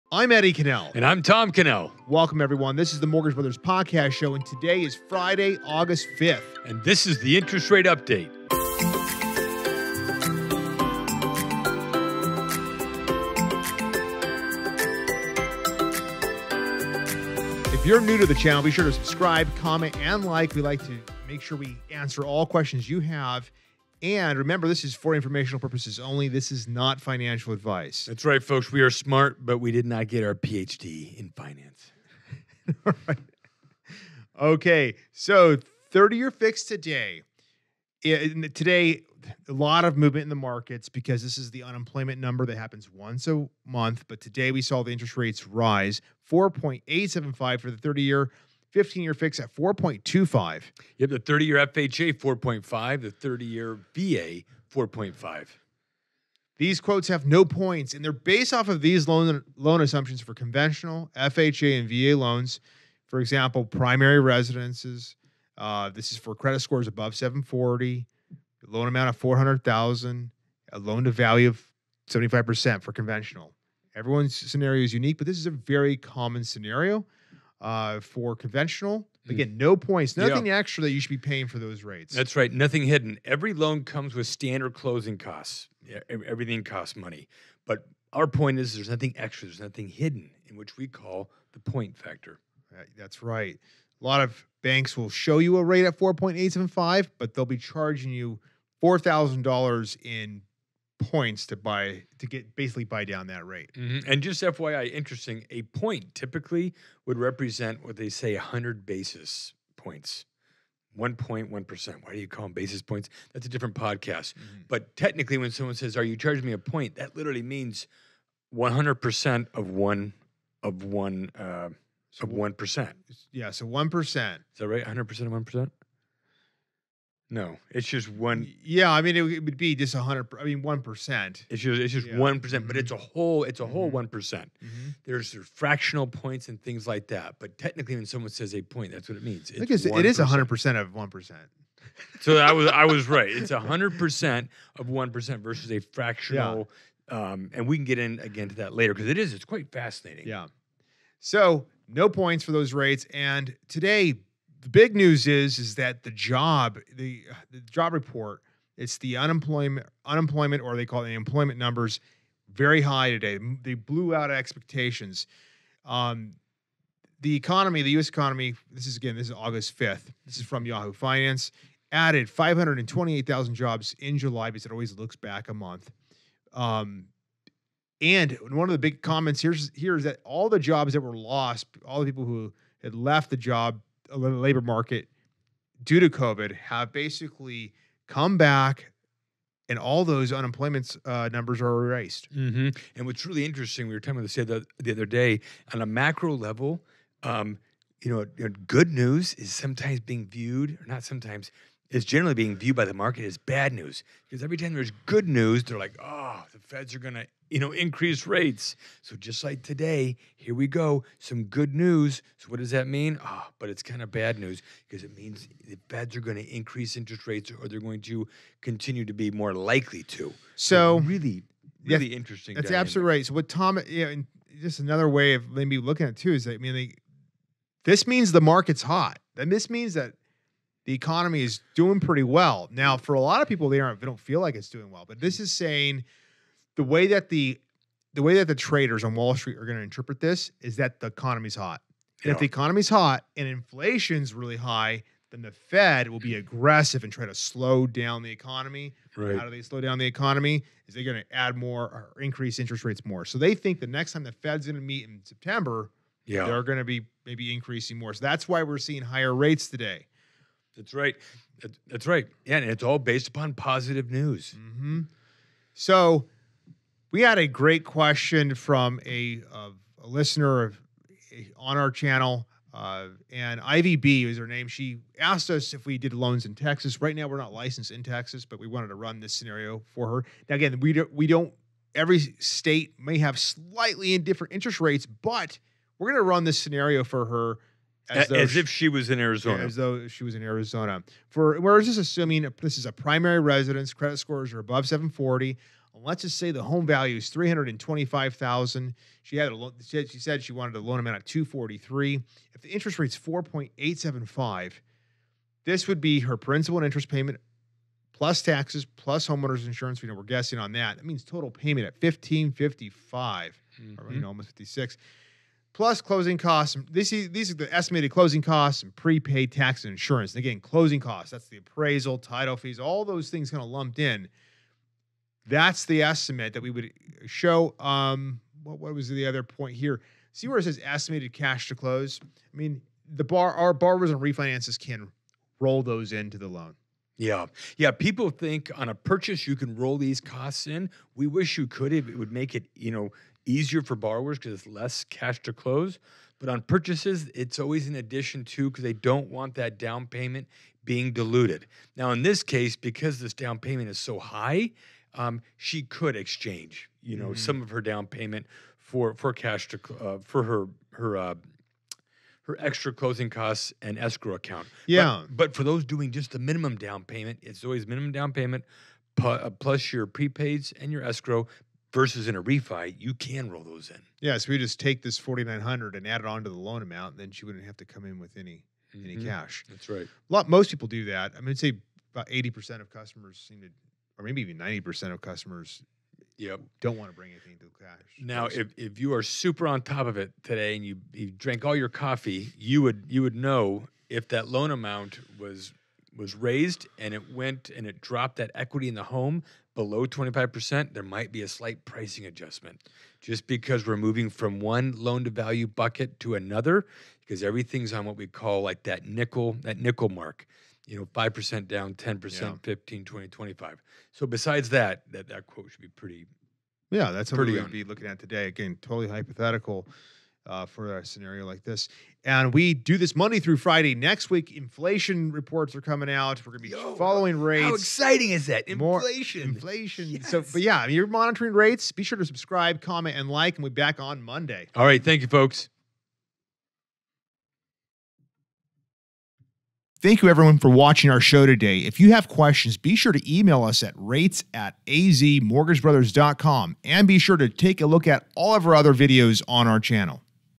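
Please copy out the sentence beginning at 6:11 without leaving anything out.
Versus in a refi, you can roll those in.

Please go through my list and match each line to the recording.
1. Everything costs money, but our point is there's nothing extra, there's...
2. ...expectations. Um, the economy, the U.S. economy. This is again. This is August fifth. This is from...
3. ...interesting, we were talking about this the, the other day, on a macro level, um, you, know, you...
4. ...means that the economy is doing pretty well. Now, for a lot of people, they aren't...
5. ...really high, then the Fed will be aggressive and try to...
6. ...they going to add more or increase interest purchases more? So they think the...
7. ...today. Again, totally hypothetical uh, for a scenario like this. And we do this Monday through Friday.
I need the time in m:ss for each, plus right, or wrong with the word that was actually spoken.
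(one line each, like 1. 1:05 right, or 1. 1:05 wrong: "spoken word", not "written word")
1. 1:26 right
2. 2:44 right
3. 3:13 right
4. 3:49 right
5. 4:04 right
6. 4:10 wrong: "rates", not "purchases"
7. 6:58 right.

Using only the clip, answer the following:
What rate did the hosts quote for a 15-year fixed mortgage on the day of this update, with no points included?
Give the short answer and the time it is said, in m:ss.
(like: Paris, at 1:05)
4.25, at 0:49.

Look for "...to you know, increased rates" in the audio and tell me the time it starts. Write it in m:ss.
3:27.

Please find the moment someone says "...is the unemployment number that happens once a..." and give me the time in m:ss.
0:41.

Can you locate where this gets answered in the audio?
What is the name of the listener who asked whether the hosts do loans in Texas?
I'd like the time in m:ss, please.
4:33.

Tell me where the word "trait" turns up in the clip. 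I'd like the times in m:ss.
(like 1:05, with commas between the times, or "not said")
not said.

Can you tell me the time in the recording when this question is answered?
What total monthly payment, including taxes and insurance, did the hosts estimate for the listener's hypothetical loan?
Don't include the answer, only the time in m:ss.
5:12.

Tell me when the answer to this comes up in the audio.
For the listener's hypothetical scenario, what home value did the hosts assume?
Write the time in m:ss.
4:57.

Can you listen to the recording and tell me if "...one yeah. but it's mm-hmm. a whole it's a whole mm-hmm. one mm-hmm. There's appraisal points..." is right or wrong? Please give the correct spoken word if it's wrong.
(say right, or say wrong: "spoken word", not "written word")
wrong: "fractional", not "appraisal".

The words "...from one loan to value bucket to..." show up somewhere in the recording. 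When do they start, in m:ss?
6:44.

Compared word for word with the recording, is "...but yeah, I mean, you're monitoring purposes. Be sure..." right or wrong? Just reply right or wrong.
wrong.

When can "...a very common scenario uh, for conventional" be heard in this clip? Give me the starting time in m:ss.
1:15.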